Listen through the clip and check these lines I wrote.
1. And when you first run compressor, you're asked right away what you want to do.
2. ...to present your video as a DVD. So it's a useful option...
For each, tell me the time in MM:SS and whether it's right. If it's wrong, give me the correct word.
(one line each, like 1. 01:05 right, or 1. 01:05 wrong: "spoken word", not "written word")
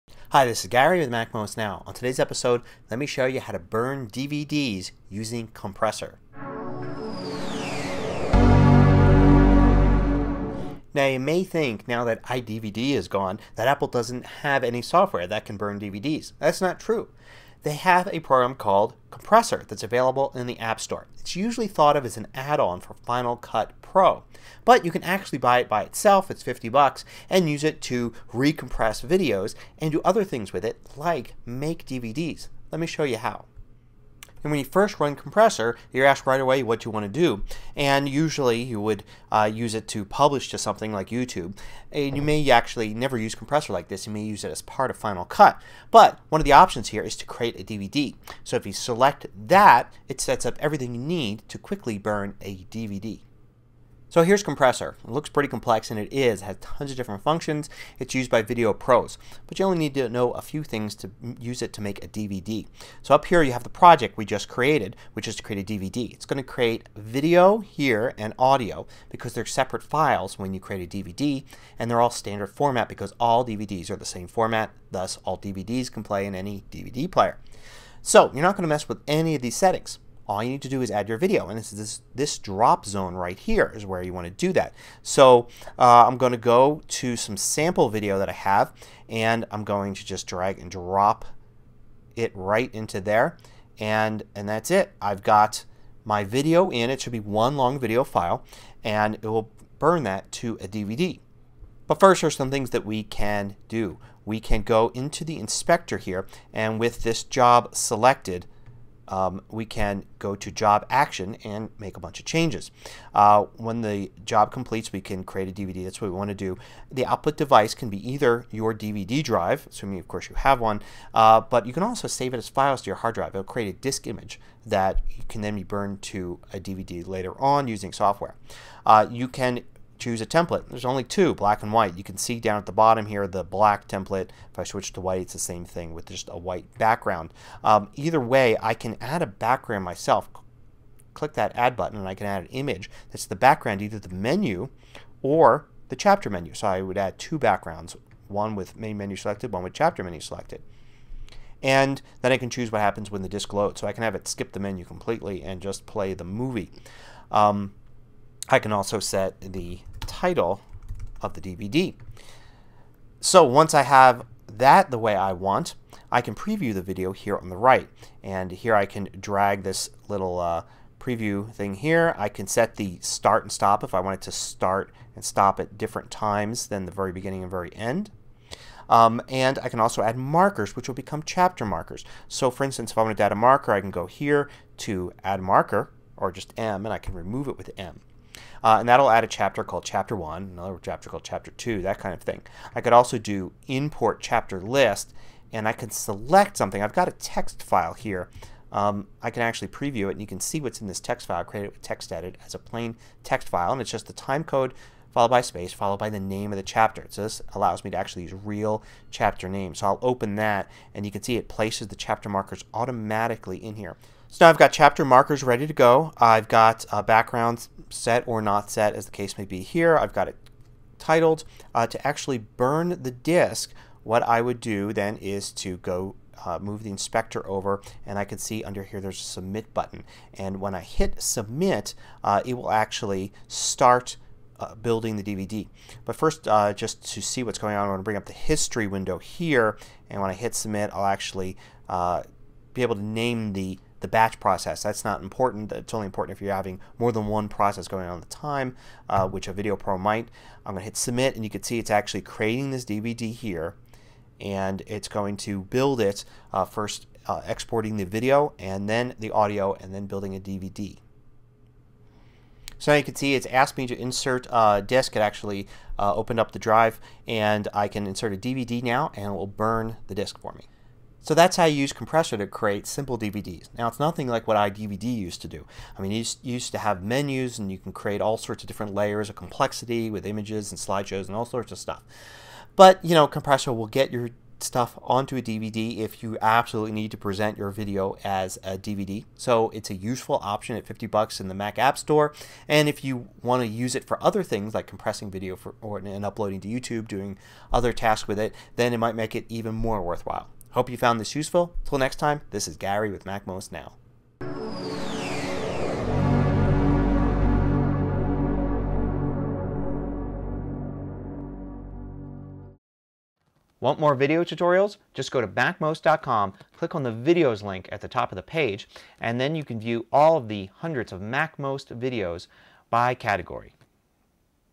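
1. 00:34 right
2. 04:47 right.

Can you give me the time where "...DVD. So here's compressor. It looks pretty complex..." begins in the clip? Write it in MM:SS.
00:52.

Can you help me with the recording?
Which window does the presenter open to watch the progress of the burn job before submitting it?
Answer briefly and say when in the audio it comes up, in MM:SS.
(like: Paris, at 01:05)
history window, at 03:58.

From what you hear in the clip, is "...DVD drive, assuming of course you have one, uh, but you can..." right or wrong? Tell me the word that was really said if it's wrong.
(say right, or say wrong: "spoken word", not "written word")
right.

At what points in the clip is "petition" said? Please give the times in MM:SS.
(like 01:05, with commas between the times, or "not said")
not said.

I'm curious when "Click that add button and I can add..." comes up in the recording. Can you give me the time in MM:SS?
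02:21.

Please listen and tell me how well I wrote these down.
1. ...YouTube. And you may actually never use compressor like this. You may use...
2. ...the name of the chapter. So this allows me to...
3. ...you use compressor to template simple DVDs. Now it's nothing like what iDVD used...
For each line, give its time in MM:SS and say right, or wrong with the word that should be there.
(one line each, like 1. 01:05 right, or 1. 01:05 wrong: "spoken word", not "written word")
1. 00:41 right
2. 03:26 right
3. 04:31 wrong: "create", not "template".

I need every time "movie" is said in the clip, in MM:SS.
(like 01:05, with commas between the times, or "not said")
02:36.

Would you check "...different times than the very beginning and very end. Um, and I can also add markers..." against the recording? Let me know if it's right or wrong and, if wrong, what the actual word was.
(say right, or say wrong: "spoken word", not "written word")
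right.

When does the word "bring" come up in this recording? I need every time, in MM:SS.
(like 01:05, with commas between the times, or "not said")
03:58.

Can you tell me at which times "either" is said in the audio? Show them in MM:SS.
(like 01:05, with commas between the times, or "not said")
01:58, 02:17, 02:23.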